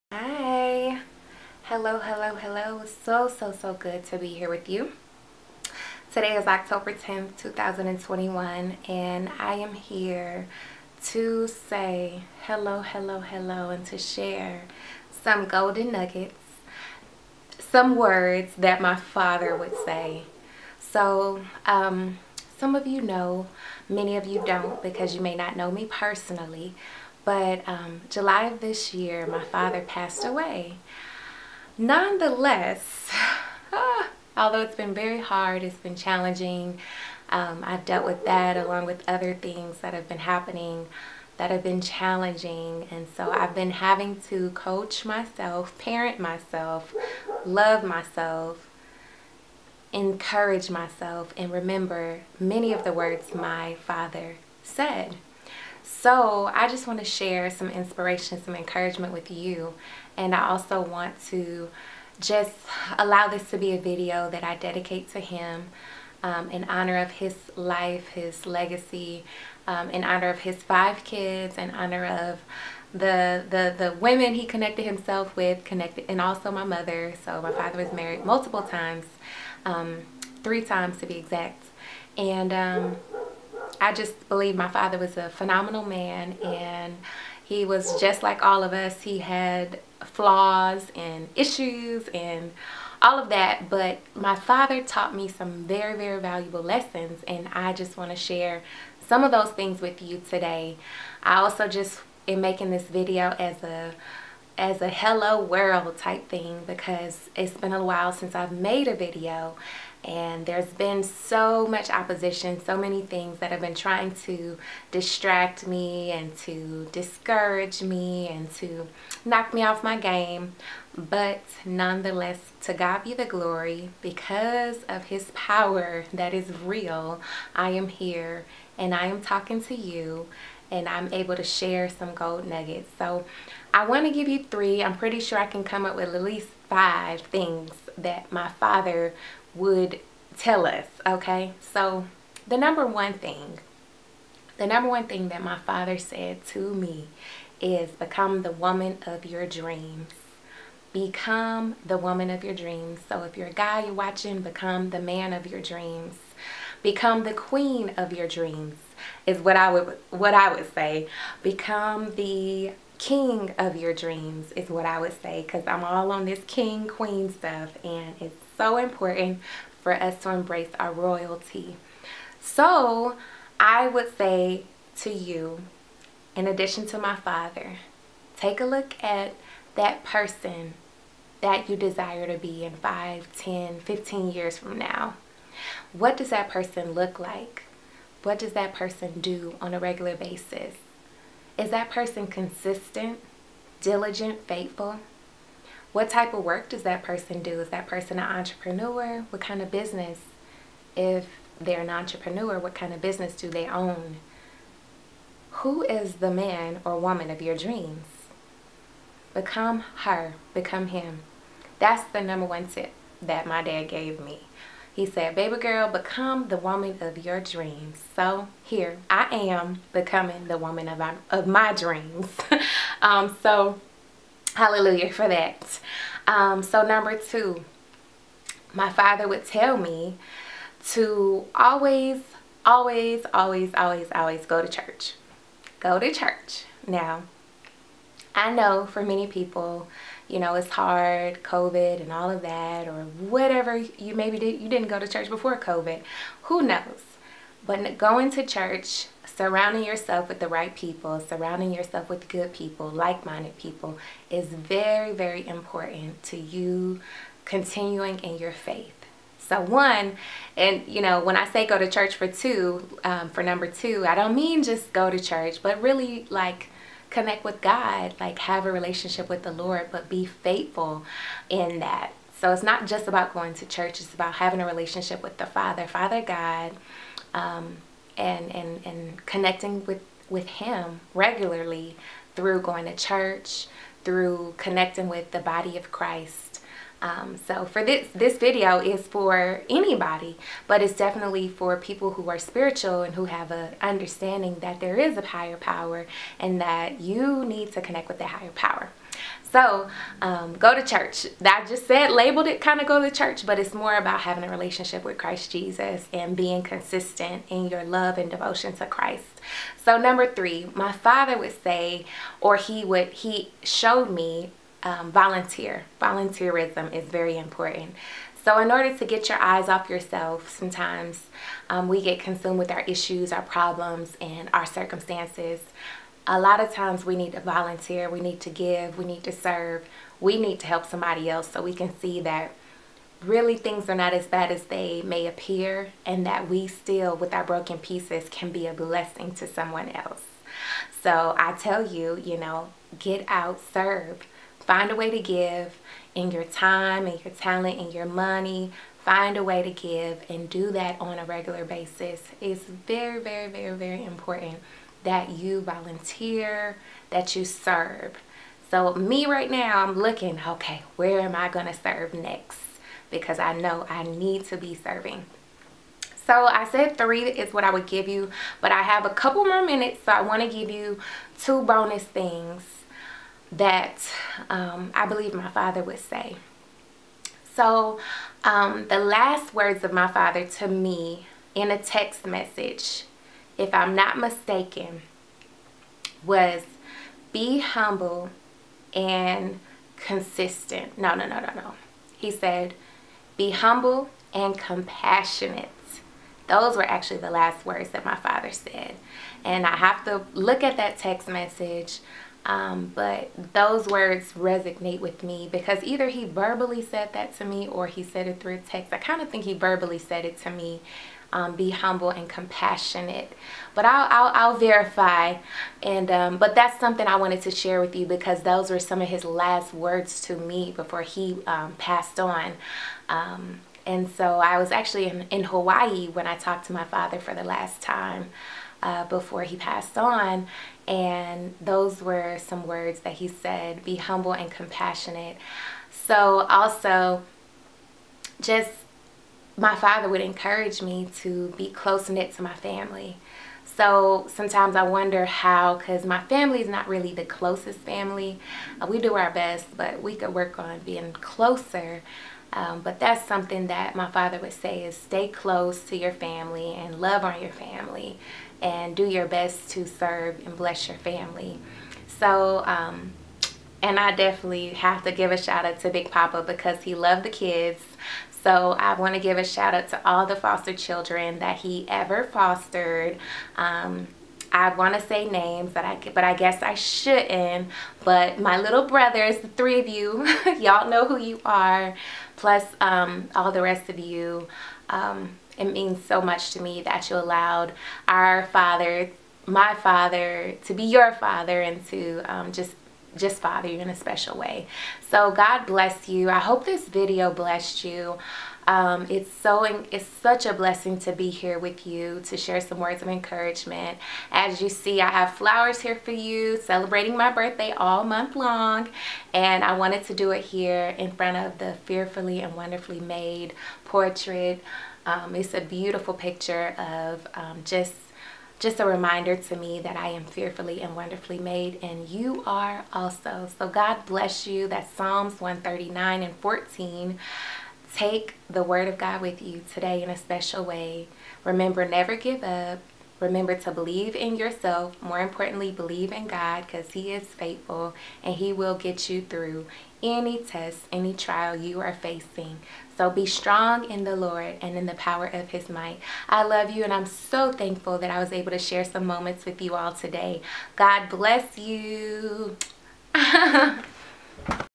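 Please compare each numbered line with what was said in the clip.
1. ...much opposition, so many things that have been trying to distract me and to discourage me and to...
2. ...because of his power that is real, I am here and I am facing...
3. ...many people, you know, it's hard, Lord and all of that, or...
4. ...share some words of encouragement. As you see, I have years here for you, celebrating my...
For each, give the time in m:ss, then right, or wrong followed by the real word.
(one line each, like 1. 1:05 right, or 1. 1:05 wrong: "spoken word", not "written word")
1. 1:51 right
2. 2:04 wrong: "talking", not "facing"
3. 3:59 wrong: "COVID", not "Lord"
4. 8:22 wrong: "flowers", not "years".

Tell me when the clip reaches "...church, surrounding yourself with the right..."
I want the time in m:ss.
4:08.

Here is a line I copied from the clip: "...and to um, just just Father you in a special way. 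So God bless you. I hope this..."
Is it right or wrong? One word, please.
right.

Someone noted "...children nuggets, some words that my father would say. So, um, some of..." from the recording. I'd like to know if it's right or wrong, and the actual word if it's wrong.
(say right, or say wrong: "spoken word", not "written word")
wrong: "golden", not "children".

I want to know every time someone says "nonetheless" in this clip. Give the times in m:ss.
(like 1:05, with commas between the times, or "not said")
0:31, 2:01.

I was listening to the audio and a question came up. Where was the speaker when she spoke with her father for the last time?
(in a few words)
Hawaii.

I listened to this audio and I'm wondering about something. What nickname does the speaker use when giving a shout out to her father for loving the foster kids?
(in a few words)
Big Papa.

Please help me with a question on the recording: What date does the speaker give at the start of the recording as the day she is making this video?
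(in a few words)
October 10th, 2021.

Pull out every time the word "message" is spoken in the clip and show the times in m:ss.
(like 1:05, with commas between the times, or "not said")
6:22, 6:41.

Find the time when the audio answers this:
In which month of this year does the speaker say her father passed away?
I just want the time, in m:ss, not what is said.
0:28.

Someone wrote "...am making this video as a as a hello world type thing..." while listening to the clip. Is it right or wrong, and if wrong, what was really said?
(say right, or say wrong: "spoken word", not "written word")
right.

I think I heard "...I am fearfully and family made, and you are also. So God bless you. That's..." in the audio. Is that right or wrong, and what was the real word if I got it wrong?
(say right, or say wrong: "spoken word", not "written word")
wrong: "wonderfully", not "family".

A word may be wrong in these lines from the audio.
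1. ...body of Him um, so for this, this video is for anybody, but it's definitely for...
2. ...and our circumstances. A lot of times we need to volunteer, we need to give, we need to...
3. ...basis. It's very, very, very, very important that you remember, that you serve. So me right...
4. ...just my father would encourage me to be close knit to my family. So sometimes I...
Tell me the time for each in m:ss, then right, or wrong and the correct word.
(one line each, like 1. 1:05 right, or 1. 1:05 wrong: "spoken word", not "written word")
1. 4:45 wrong: "Christ", not "Him"
2. 5:24 right
3. 5:51 wrong: "volunteer", not "remember"
4. 7:18 right.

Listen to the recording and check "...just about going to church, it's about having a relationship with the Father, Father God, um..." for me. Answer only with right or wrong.
right.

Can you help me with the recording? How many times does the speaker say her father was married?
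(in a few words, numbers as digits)
3.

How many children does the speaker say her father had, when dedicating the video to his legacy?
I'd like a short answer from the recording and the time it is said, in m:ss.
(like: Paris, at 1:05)
5, at 1:10.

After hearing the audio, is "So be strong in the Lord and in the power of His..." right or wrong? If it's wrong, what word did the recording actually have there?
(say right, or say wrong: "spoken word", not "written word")
right.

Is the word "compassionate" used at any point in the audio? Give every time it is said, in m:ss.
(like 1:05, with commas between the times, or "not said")
6:34, 6:52, 7:14.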